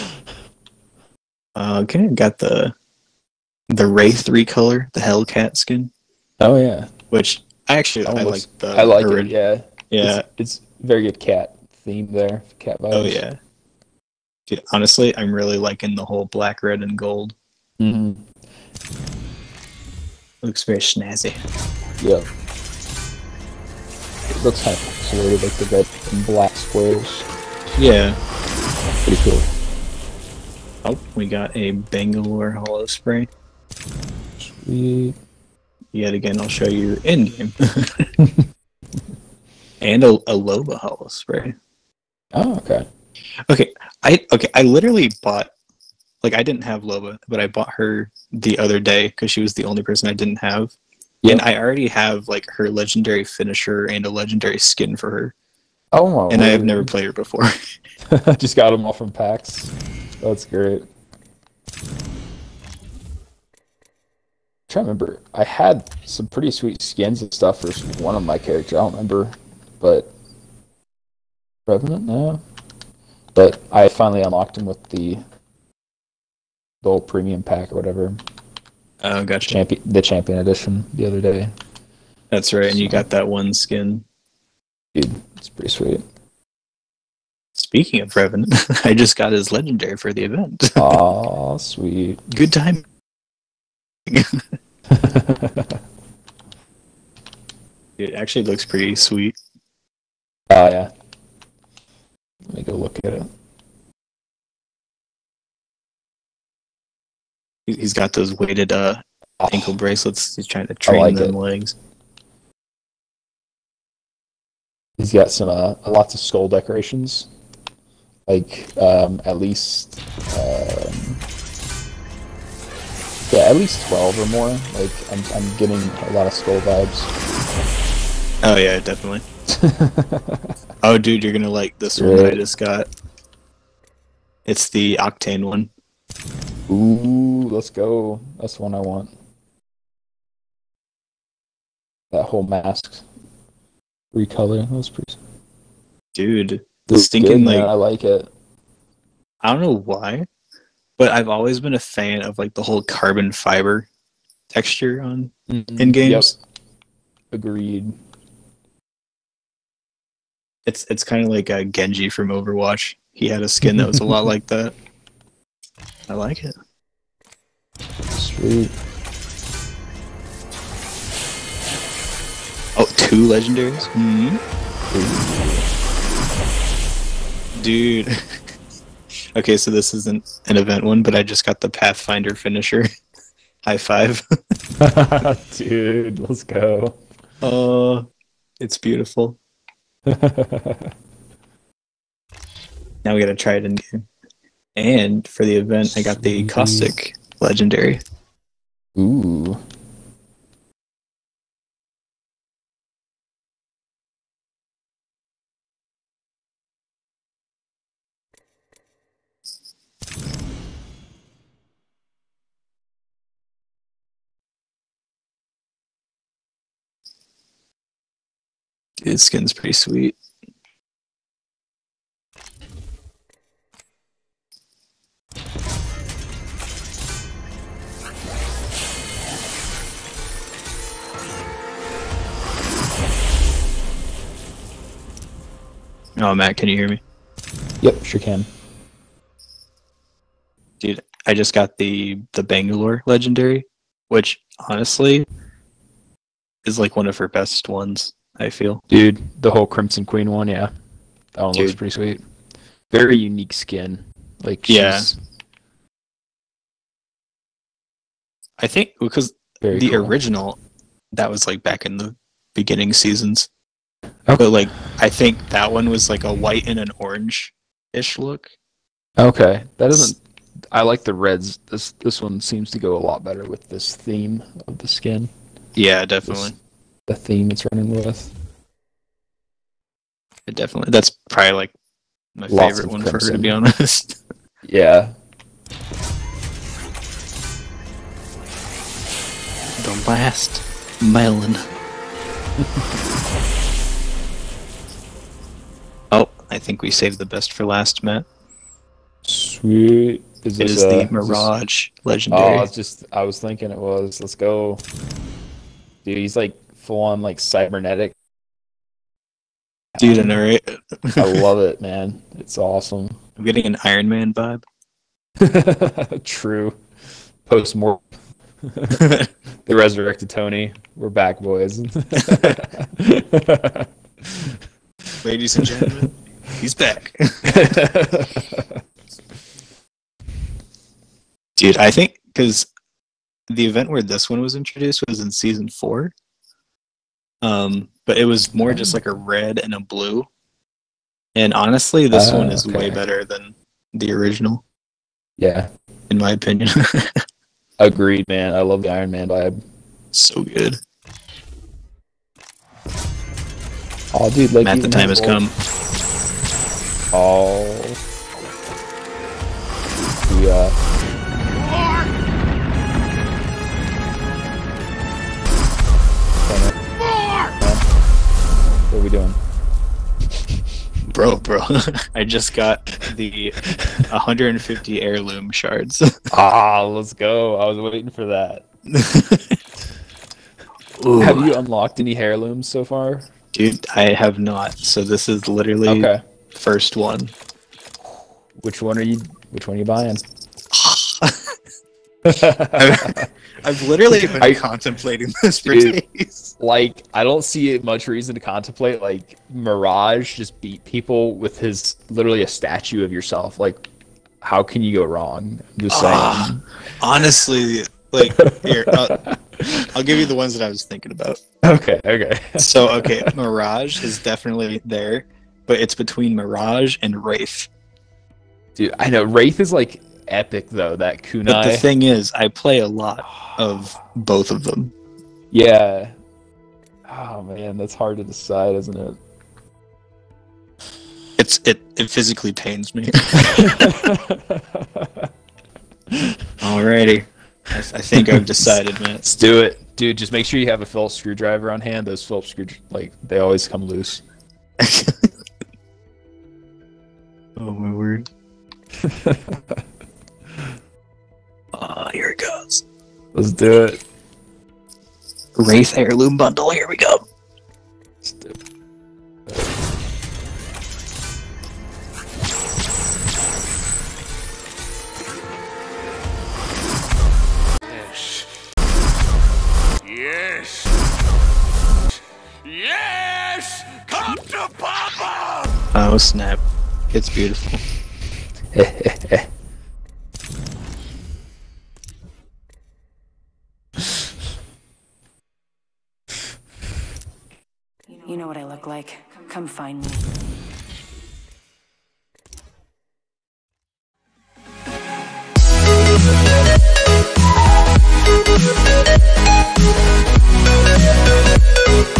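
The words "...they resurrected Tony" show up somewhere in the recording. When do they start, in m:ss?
5:18.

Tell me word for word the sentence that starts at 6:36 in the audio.
Like, I don't see much reason to contemplate.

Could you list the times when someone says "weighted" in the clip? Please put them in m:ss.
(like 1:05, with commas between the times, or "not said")
1:48.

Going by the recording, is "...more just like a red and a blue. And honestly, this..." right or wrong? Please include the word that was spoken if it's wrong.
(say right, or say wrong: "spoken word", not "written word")
right.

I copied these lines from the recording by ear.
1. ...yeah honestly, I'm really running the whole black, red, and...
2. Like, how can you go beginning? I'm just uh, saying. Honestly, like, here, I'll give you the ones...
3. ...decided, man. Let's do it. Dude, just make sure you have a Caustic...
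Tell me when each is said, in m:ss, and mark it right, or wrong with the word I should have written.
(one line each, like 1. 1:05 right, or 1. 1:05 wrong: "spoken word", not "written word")
1. 0:13 wrong: "liking", not "running"
2. 6:43 wrong: "wrong", not "beginning"
3. 7:18 wrong: "Phillips", not "Caustic".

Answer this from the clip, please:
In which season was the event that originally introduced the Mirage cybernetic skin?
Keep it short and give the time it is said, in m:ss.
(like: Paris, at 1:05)
season 4, at 5:35.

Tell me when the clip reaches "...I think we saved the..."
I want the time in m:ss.
4:56.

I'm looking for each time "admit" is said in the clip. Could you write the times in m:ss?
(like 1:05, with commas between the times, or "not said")
not said.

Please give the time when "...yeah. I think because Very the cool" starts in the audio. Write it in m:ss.
4:14.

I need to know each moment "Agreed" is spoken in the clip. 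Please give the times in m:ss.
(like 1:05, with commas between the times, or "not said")
2:37, 5:47.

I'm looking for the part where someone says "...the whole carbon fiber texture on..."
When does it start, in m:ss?
2:32.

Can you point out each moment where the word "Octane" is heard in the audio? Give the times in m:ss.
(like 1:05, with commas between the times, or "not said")
2:14.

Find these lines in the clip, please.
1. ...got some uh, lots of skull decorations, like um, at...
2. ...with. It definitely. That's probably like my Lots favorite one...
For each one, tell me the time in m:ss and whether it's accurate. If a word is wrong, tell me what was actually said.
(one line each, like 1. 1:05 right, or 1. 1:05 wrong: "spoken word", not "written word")
1. 1:55 right
2. 4:37 right.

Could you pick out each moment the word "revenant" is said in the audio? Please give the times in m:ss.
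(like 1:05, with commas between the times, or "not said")
1:11, 1:28.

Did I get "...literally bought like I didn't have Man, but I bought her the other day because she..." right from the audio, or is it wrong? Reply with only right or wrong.
wrong.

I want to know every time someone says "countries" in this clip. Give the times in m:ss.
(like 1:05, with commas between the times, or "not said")
not said.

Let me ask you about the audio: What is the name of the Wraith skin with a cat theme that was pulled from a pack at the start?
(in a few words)
Hellcat.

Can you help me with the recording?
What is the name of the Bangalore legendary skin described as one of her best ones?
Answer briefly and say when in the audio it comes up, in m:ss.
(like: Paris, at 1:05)
Crimson Queen, at 4:09.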